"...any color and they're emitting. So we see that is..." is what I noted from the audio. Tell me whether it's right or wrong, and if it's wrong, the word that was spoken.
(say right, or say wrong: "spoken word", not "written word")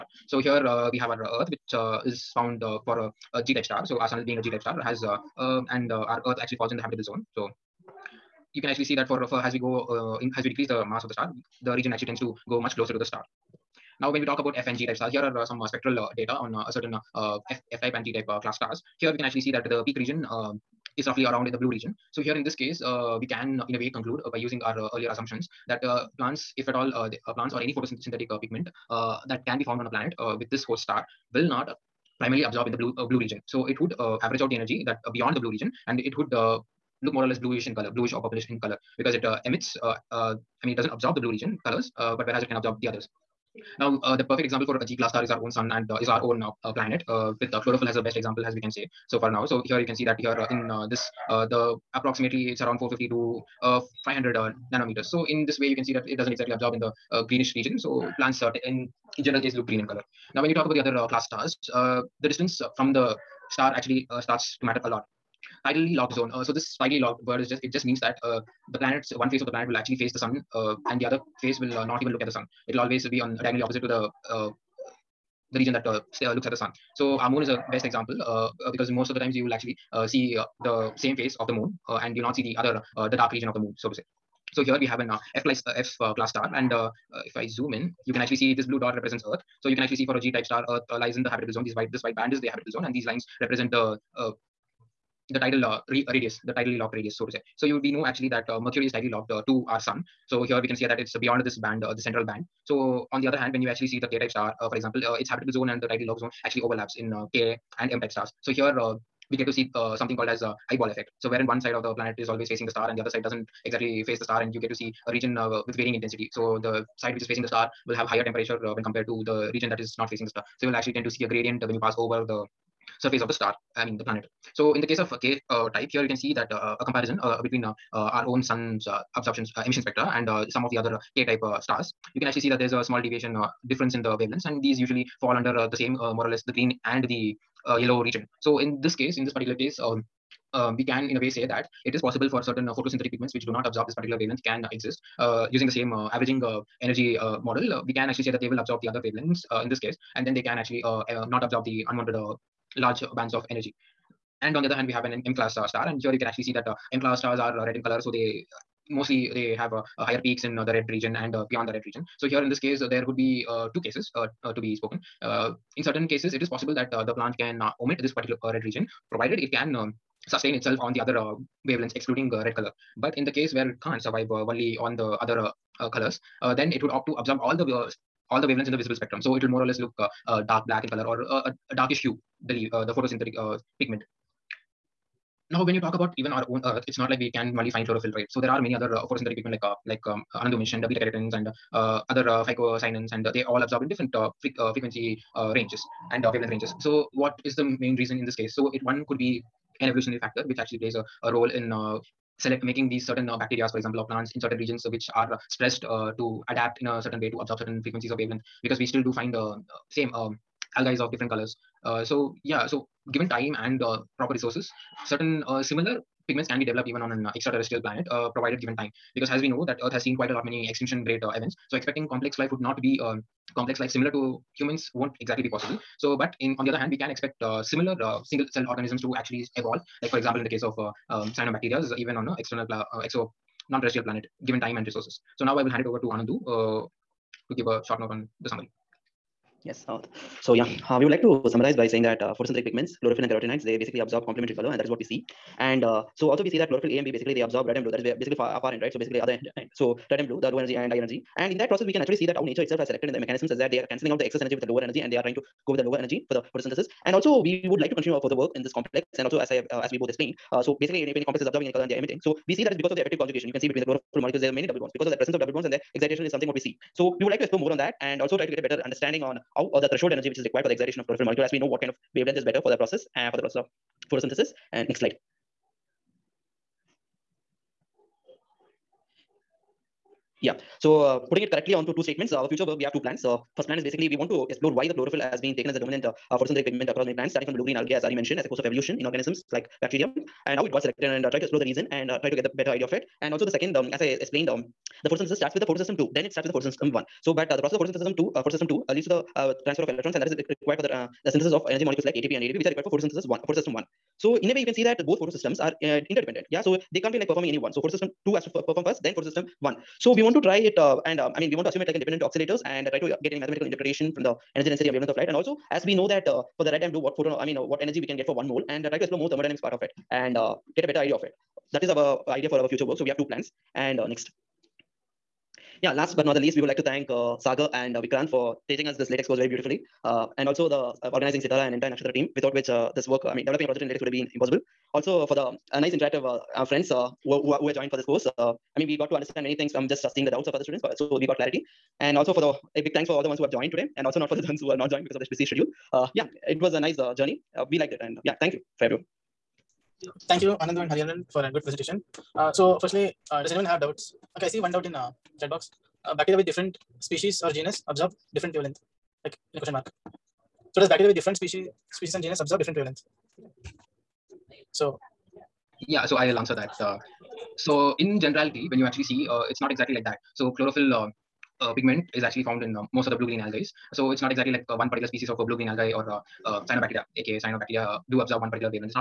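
right.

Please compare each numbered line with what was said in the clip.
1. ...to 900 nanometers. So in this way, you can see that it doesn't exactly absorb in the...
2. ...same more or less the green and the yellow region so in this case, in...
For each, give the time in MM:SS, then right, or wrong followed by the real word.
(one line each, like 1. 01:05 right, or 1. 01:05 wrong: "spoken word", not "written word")
1. 00:53 wrong: "500", not "900"
2. 02:15 right.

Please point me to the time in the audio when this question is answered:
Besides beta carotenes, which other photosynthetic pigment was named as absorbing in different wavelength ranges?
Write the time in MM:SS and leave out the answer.
03:12.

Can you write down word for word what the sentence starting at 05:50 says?
Thank you, Anandhu and Hariharan, for a good presentation.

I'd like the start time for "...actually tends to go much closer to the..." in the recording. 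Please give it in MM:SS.
00:11.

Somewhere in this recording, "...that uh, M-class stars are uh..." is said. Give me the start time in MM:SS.
02:36.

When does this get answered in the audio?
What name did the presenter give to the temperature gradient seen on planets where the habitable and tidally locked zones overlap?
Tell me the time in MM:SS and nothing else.
01:50.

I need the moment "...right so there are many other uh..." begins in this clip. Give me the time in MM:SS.
03:08.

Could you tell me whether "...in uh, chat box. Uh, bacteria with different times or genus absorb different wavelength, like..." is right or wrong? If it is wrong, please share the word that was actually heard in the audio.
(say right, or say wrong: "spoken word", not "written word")
wrong: "species", not "times".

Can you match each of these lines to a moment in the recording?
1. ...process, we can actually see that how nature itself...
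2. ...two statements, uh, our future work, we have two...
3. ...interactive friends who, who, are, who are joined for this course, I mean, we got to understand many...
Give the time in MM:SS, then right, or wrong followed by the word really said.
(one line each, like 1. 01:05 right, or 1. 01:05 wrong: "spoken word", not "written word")
1. 04:11 right
2. 04:41 right
3. 05:35 right.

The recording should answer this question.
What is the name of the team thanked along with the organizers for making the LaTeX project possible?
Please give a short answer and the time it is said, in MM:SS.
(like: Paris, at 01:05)
Naxxatra, at 05:31.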